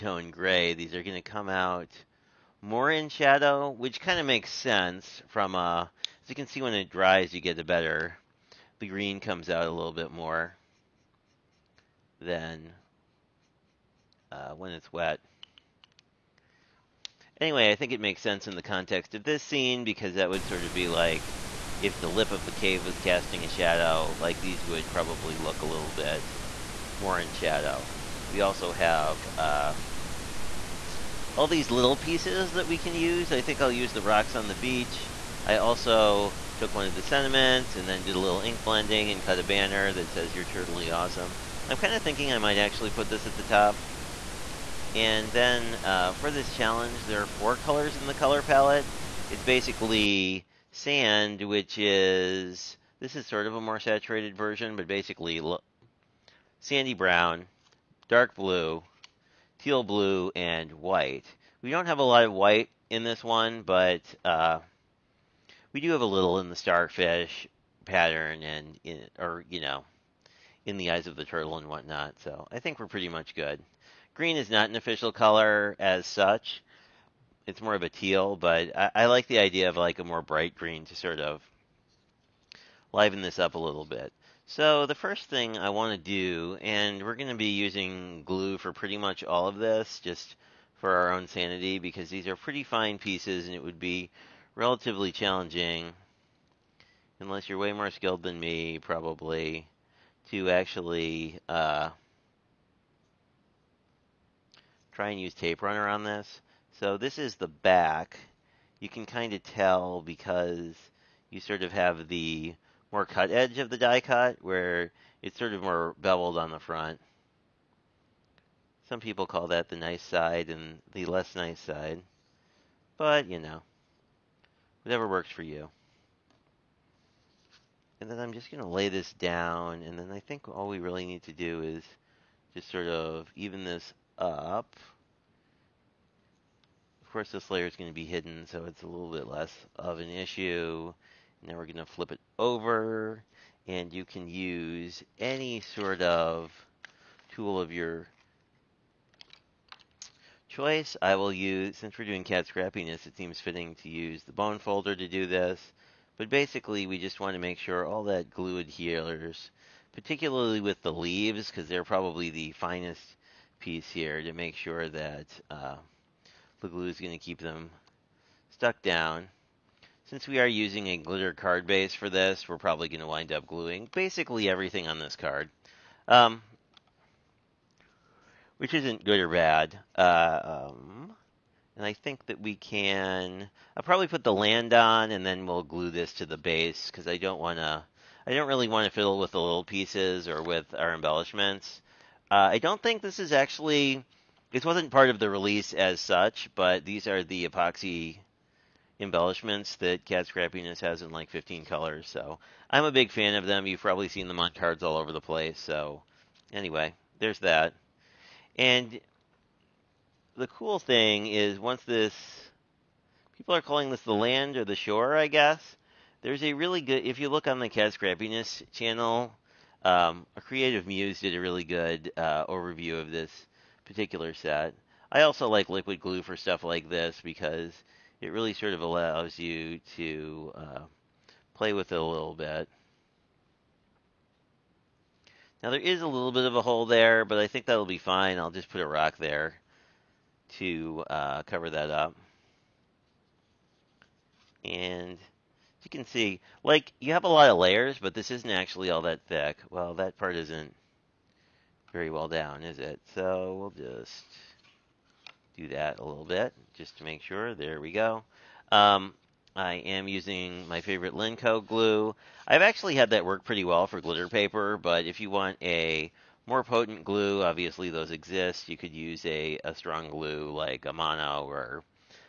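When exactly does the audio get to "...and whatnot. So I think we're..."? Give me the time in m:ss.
1:11.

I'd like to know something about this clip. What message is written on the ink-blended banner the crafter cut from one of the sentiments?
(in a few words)
You're totally awesome.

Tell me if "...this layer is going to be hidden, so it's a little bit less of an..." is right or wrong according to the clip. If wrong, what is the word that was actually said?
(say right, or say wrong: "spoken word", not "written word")
right.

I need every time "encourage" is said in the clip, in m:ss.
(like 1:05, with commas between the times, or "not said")
not said.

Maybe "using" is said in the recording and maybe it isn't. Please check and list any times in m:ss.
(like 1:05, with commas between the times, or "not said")
1:27, 2:50, 4:20.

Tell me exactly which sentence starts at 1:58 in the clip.
Some people call that the nice side and the less nice side.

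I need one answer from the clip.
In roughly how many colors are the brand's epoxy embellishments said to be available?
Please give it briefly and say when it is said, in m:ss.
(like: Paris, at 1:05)
15, at 3:21.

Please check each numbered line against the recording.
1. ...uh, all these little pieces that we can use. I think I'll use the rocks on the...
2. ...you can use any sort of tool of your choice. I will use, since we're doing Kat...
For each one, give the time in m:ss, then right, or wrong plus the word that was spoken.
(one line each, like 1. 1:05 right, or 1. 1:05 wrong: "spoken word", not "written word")
1. 0:29 right
2. 2:23 right.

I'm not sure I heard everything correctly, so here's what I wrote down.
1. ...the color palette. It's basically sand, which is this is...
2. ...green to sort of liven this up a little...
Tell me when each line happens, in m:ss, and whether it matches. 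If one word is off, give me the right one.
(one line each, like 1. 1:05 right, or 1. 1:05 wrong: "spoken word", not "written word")
1. 0:48 right
2. 1:20 right.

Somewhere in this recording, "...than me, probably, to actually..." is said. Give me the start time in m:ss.
1:38.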